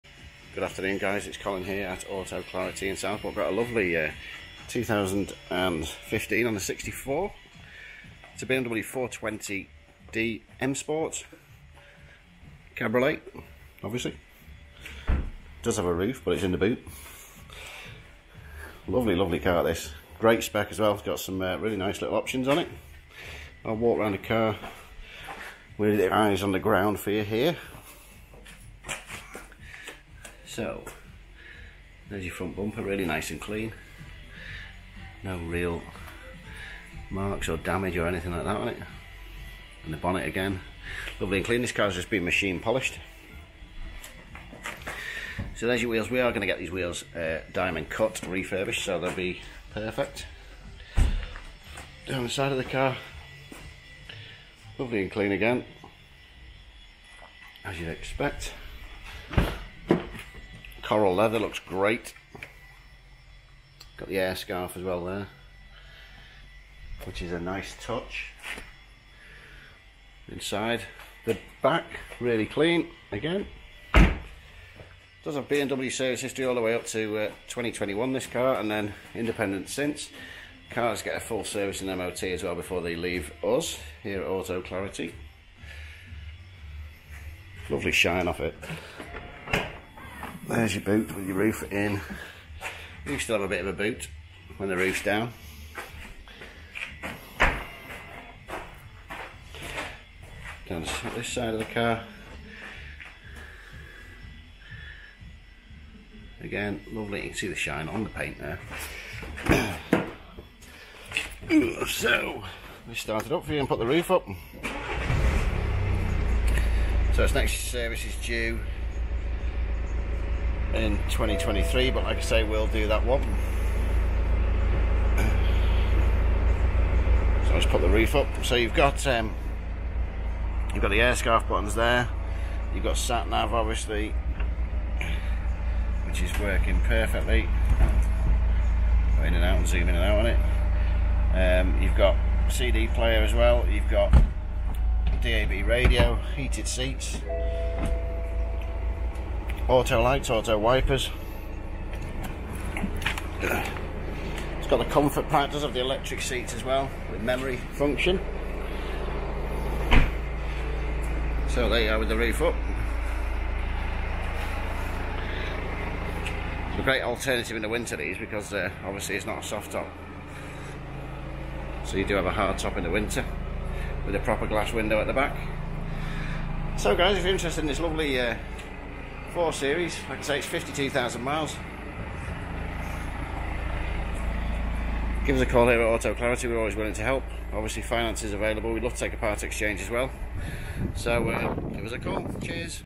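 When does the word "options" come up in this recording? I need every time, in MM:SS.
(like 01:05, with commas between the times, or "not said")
00:22.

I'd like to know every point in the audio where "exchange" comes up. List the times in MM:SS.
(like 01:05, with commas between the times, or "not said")
03:09.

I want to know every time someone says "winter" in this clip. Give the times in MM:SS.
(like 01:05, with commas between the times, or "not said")
02:47, 02:52.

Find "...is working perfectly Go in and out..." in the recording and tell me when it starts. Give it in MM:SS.
02:16.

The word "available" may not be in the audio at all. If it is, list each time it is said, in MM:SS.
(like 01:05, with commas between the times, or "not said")
03:08.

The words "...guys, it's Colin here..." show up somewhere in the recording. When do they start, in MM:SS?
00:00.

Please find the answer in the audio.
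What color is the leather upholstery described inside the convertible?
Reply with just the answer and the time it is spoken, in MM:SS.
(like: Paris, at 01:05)
Coral, at 01:00.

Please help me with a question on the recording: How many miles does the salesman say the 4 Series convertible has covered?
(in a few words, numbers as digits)
52,000.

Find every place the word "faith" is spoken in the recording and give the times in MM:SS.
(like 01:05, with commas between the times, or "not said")
not said.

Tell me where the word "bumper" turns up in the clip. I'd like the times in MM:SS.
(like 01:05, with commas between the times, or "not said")
00:32.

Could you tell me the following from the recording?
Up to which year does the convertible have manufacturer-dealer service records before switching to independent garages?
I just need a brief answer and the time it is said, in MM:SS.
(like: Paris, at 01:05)
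2021, at 01:17.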